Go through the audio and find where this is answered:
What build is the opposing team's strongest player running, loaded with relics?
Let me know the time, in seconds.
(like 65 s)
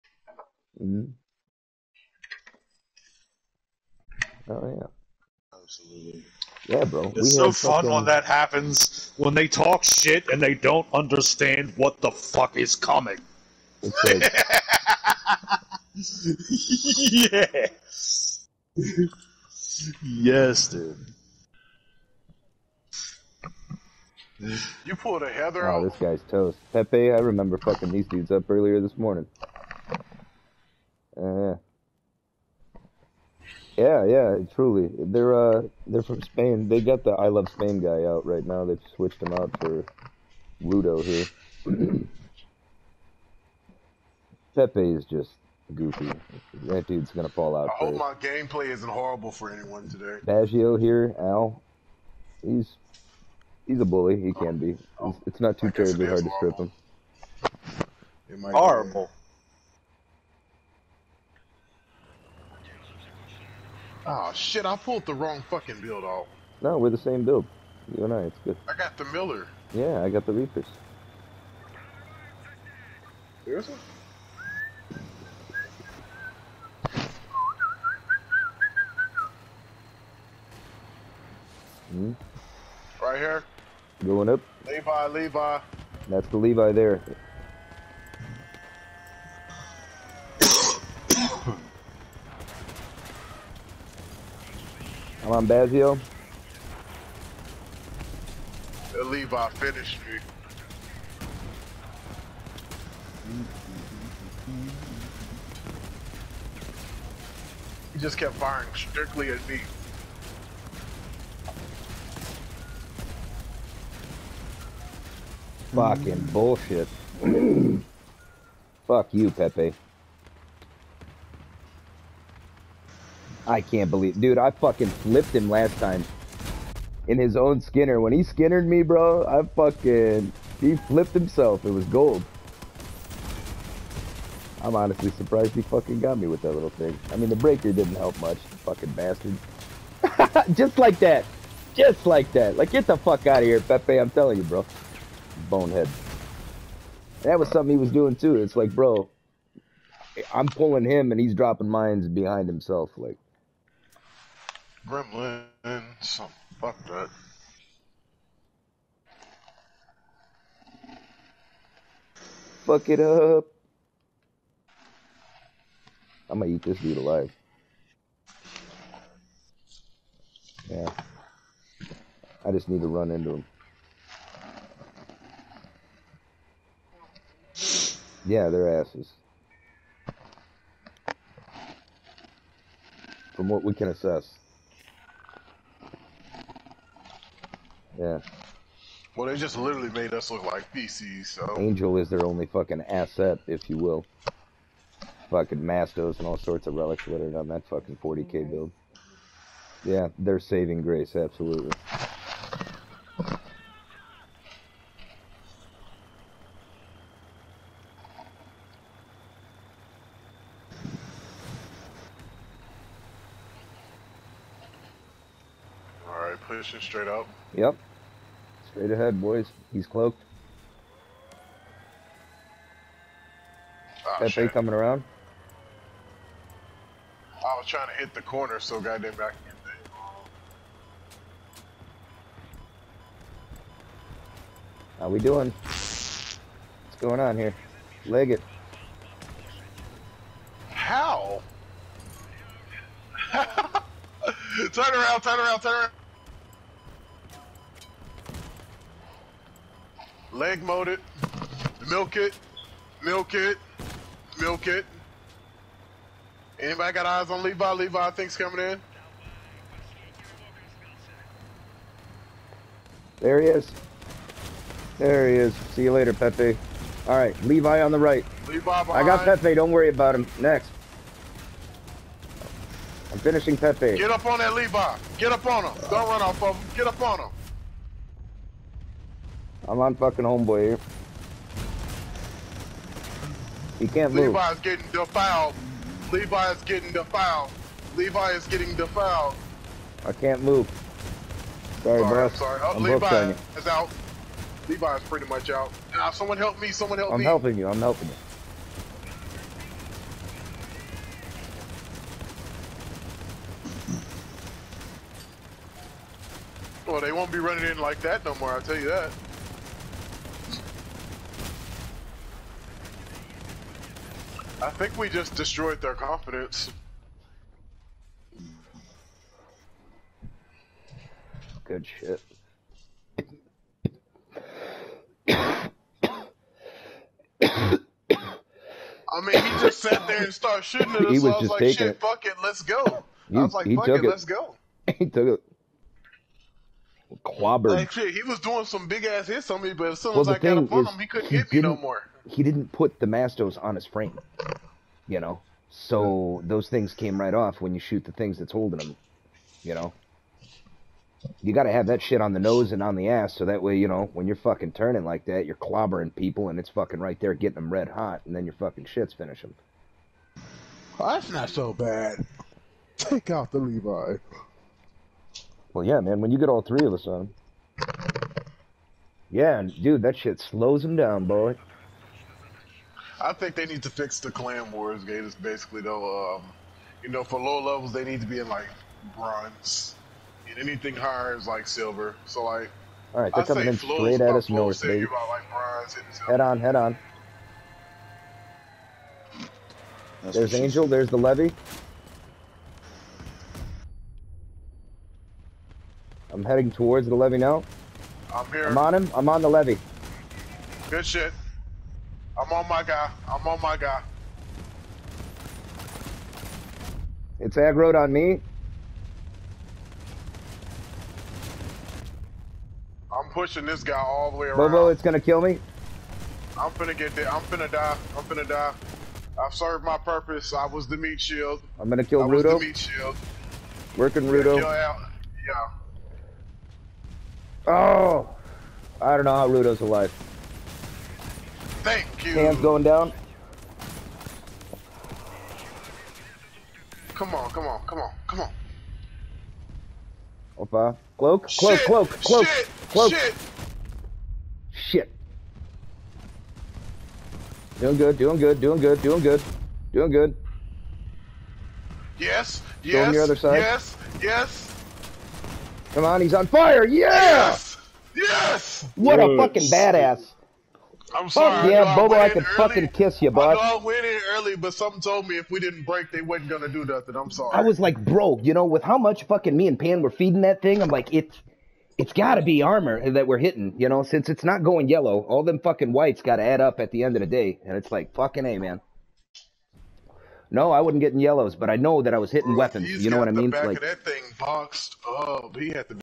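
198 s.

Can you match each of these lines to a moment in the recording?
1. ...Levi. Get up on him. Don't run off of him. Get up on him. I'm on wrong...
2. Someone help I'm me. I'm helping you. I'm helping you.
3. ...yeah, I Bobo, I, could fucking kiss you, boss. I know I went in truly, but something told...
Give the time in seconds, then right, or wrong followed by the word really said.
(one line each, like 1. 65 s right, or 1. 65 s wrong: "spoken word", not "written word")
1. 274 s wrong: "fucking", not "wrong"
2. 296 s right
3. 461 s wrong: "early", not "truly".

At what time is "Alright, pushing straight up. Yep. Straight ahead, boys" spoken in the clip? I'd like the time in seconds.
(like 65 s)
216 s.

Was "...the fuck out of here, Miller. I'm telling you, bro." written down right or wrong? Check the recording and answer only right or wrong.
wrong.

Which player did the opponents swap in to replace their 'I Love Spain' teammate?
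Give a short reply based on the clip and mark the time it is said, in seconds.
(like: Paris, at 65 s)
Ludo, at 40 s.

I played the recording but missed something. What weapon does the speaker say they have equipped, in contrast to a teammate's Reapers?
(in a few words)
Miller.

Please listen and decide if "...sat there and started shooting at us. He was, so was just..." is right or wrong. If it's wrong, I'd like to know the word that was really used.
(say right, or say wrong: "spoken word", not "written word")
right.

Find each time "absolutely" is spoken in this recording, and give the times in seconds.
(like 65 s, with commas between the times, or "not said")
5 s, 201 s.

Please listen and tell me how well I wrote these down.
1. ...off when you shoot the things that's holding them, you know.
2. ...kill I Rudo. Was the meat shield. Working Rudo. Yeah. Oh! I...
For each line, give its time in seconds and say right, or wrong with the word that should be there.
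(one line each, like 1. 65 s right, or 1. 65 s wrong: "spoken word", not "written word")
1. 347 s right
2. 422 s right.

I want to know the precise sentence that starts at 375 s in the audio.
It's basically though, um, you know, for low levels they need to be in like bronze, and anything higher is like silver.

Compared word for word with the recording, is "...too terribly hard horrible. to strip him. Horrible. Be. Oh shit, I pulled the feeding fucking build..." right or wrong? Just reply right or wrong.
wrong.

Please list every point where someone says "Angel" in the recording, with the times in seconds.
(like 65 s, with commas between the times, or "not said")
191 s, 390 s.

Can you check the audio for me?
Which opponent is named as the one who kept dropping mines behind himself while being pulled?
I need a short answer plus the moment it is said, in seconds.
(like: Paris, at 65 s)
Gremlin, at 154 s.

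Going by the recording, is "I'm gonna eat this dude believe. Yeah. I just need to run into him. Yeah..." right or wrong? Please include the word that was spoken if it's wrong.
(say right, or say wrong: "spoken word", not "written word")
wrong: "alive", not "believe".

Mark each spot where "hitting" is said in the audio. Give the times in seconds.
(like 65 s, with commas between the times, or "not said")
473 s, 482 s.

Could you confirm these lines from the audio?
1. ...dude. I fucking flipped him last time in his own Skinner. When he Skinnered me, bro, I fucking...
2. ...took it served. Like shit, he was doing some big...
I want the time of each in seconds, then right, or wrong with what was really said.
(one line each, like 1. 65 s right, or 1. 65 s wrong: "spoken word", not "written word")
1. 124 s right
2. 335 s wrong: "clobbered", not "served".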